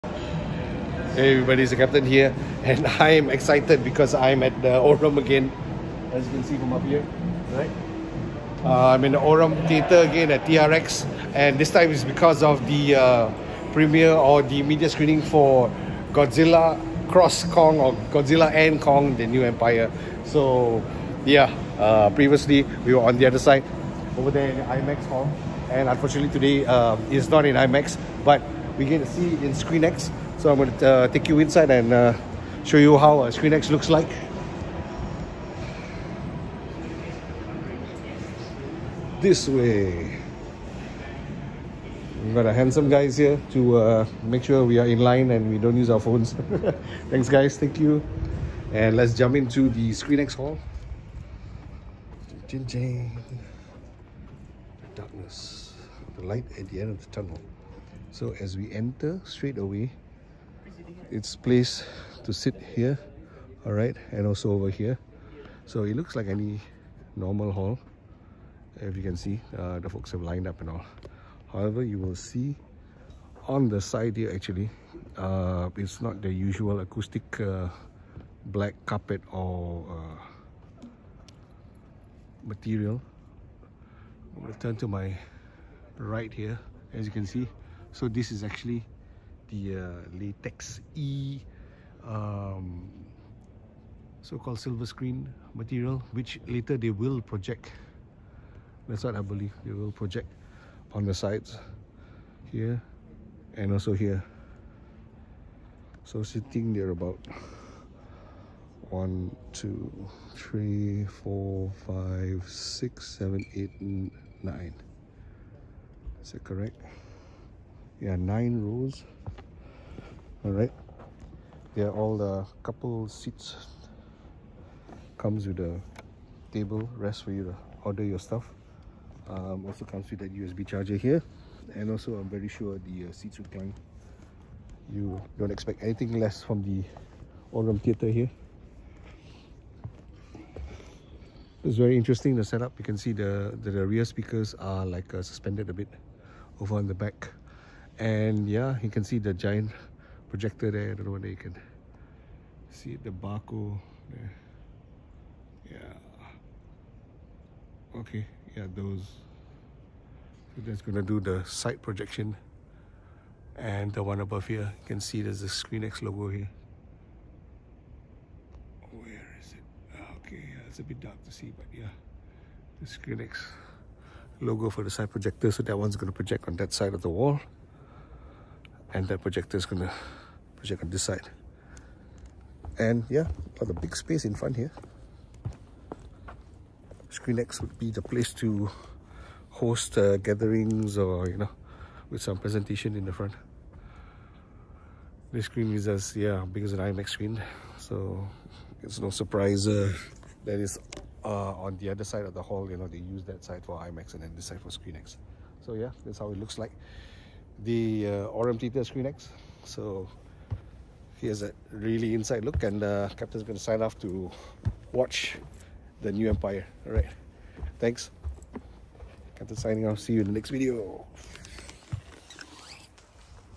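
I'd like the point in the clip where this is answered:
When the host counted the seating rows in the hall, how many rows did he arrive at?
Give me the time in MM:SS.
01:58.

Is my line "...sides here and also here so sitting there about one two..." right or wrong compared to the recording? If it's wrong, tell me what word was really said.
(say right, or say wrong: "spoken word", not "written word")
right.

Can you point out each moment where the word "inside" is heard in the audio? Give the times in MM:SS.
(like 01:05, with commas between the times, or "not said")
00:31, 03:32.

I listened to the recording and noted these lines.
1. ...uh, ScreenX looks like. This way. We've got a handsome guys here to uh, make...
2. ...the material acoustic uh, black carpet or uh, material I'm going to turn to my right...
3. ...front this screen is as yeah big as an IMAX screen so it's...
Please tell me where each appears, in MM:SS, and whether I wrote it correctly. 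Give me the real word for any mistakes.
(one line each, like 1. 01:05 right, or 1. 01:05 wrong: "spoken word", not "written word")
1. 00:33 right
2. 01:16 wrong: "usual", not "material"
3. 03:13 right.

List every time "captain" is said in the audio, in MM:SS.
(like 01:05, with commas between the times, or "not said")
00:01, 03:33, 03:39.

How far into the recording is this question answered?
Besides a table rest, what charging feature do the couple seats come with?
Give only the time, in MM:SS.
02:10.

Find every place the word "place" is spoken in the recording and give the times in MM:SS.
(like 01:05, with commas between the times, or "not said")
01:01, 03:08.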